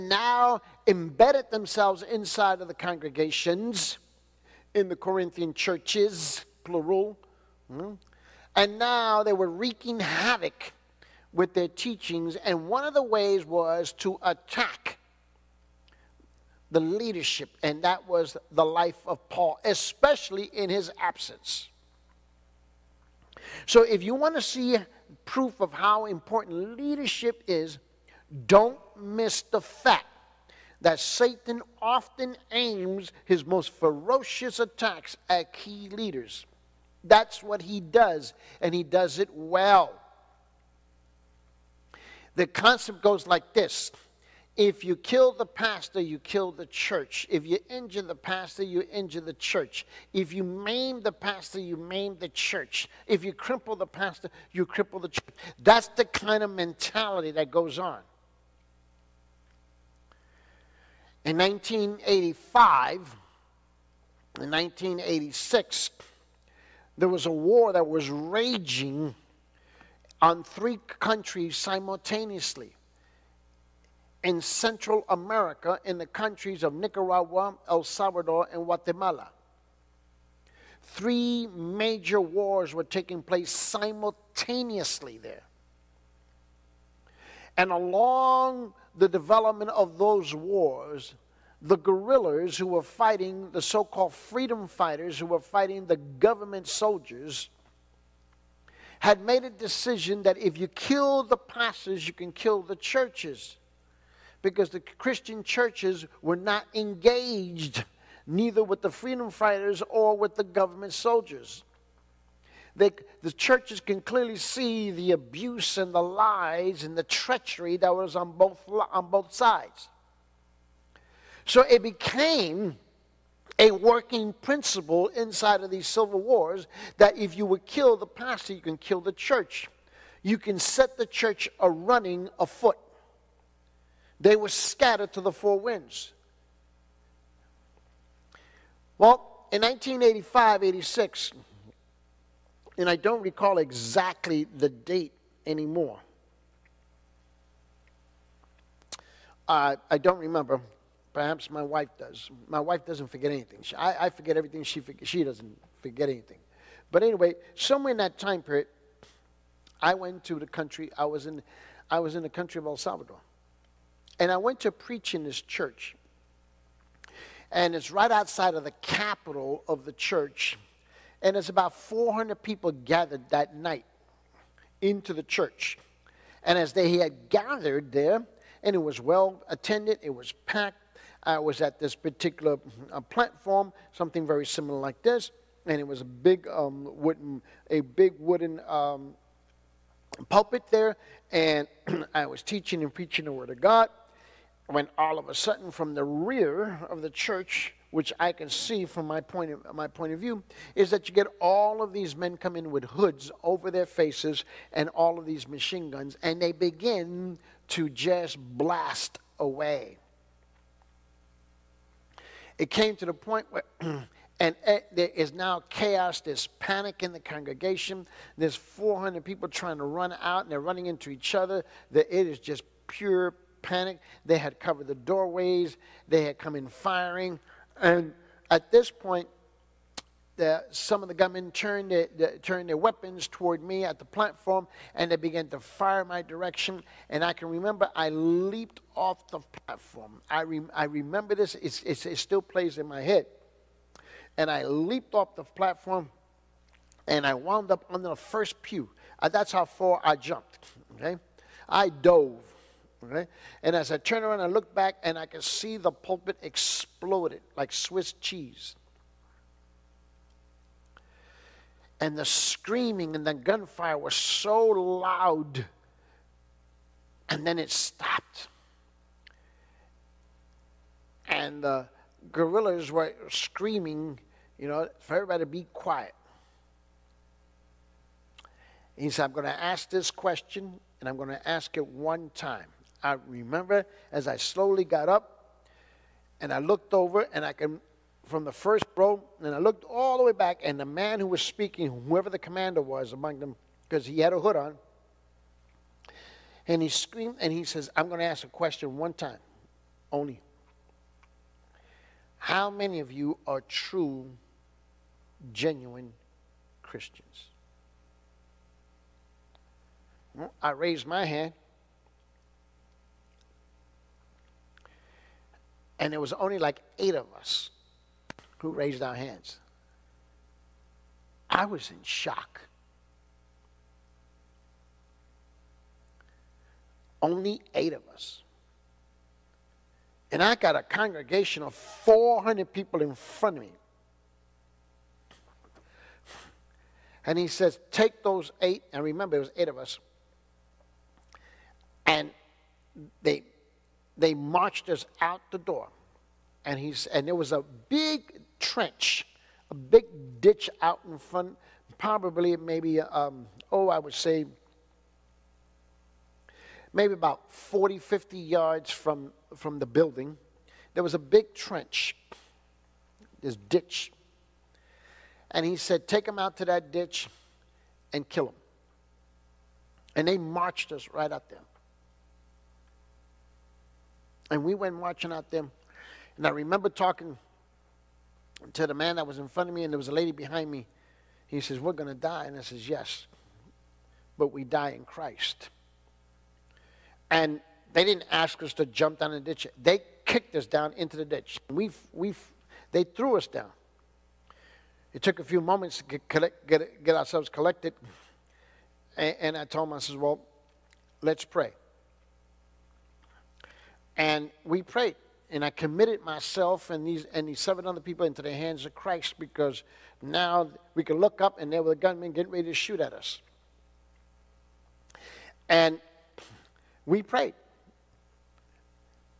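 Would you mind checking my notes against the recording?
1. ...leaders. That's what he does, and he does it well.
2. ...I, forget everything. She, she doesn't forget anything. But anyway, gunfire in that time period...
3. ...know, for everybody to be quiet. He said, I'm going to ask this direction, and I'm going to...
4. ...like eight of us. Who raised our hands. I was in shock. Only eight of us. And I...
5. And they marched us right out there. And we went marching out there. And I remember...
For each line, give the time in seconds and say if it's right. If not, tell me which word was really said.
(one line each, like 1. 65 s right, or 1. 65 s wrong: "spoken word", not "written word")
1. 35 s right
2. 154 s wrong: "somewhere", not "gunfire"
3. 274 s wrong: "question", not "direction"
4. 316 s right
5. 370 s right.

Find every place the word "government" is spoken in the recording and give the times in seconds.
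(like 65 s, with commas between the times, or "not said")
95 s, 110 s.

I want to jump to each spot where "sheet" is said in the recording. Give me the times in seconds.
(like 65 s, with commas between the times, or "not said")
not said.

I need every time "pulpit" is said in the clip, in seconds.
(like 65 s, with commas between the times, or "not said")
190 s, 255 s.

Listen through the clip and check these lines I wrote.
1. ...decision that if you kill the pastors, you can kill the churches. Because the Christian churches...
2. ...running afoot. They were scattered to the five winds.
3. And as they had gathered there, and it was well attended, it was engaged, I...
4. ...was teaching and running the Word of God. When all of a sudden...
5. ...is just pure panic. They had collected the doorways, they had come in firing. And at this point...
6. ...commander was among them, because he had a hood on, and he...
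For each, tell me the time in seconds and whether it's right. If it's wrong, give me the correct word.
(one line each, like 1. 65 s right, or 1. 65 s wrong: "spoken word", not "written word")
1. 99 s right
2. 131 s wrong: "four", not "five"
3. 176 s wrong: "packed", not "engaged"
4. 192 s wrong: "preaching", not "running"
5. 222 s wrong: "covered", not "collected"
6. 292 s right.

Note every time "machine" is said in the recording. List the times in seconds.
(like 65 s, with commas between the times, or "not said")
205 s.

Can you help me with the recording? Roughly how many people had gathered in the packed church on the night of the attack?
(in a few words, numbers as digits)
400.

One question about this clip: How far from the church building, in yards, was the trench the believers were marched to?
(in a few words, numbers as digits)
40 to 50 yards.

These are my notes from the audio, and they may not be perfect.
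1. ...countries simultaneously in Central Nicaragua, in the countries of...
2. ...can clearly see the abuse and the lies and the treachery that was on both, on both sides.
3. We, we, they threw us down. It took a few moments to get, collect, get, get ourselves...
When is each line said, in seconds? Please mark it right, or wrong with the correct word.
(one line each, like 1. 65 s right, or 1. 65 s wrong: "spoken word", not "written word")
1. 70 s wrong: "America", not "Nicaragua"
2. 113 s right
3. 391 s right.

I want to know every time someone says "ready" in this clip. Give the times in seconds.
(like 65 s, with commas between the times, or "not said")
412 s.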